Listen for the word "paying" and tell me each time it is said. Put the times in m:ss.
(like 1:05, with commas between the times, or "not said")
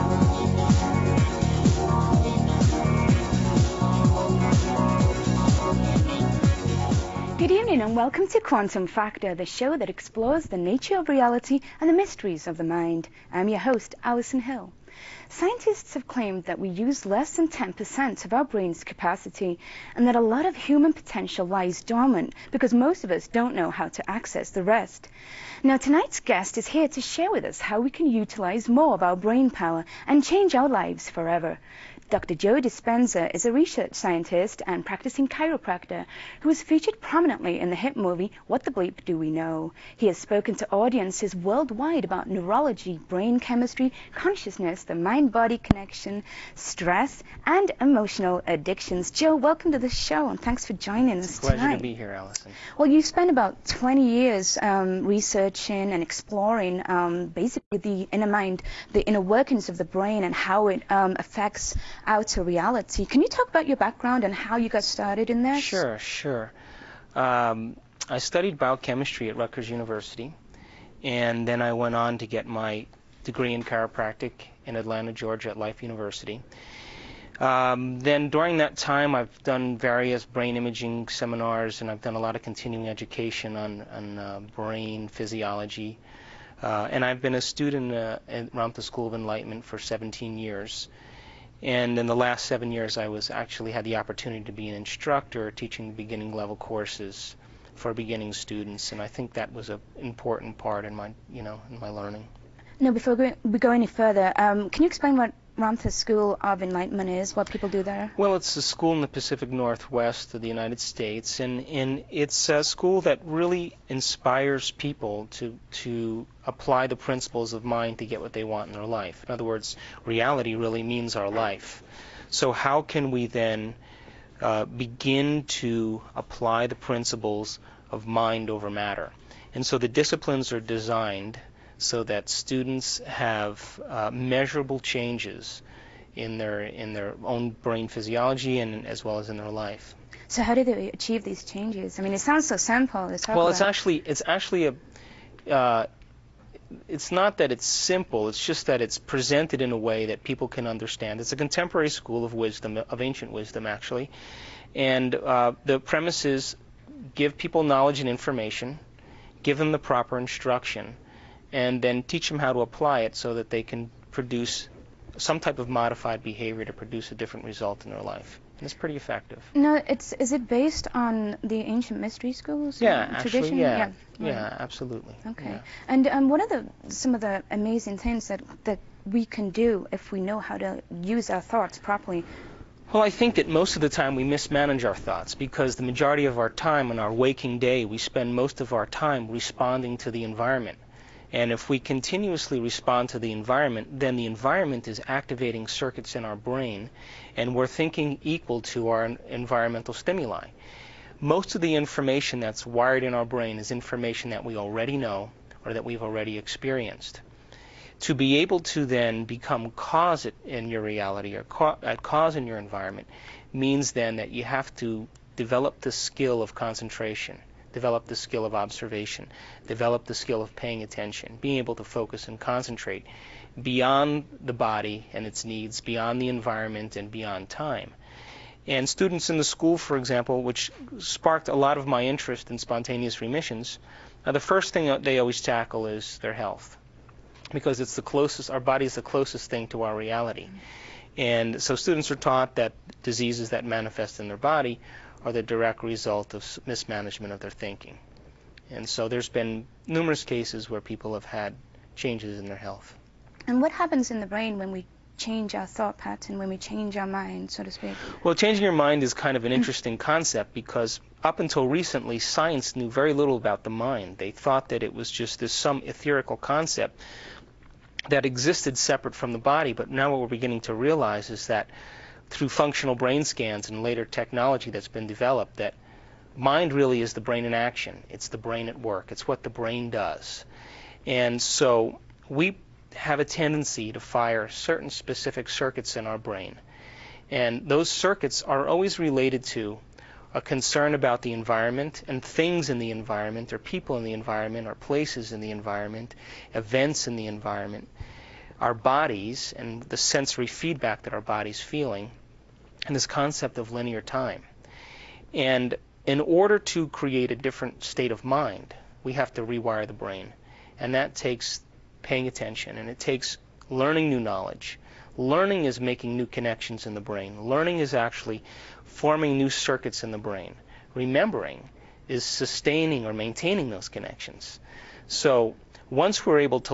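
3:40, 5:12.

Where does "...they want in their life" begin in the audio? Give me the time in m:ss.
1:58.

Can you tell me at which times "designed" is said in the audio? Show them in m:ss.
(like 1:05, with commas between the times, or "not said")
2:10.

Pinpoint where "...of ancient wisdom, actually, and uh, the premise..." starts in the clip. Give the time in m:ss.
2:32.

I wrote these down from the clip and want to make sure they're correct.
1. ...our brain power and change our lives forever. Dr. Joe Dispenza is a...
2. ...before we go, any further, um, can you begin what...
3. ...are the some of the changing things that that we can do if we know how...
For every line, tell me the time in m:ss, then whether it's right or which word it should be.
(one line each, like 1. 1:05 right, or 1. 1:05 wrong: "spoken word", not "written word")
1. 0:29 right
2. 1:42 wrong: "explain", not "begin"
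3. 2:56 wrong: "amazing", not "changing".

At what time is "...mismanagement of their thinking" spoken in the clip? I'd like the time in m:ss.
4:06.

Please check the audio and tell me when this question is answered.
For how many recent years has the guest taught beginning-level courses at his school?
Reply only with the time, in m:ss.
1:32.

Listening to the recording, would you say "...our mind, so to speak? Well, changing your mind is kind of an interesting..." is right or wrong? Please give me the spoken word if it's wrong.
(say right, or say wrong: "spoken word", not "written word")
right.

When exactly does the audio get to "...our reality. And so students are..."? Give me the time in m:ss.
3:59.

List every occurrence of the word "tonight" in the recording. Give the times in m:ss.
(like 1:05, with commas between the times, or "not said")
0:25, 0:51.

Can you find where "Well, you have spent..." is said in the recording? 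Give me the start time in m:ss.
0:52.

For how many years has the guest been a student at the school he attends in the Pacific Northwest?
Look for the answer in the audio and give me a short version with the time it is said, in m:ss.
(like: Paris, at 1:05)
17, at 1:29.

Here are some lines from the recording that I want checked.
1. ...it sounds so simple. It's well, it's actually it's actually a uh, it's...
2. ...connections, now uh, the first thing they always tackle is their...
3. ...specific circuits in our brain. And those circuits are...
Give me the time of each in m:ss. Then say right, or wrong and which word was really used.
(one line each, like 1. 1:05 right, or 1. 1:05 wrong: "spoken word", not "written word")
1. 2:22 right
2. 3:53 wrong: "remissions", not "connections"
3. 4:44 right.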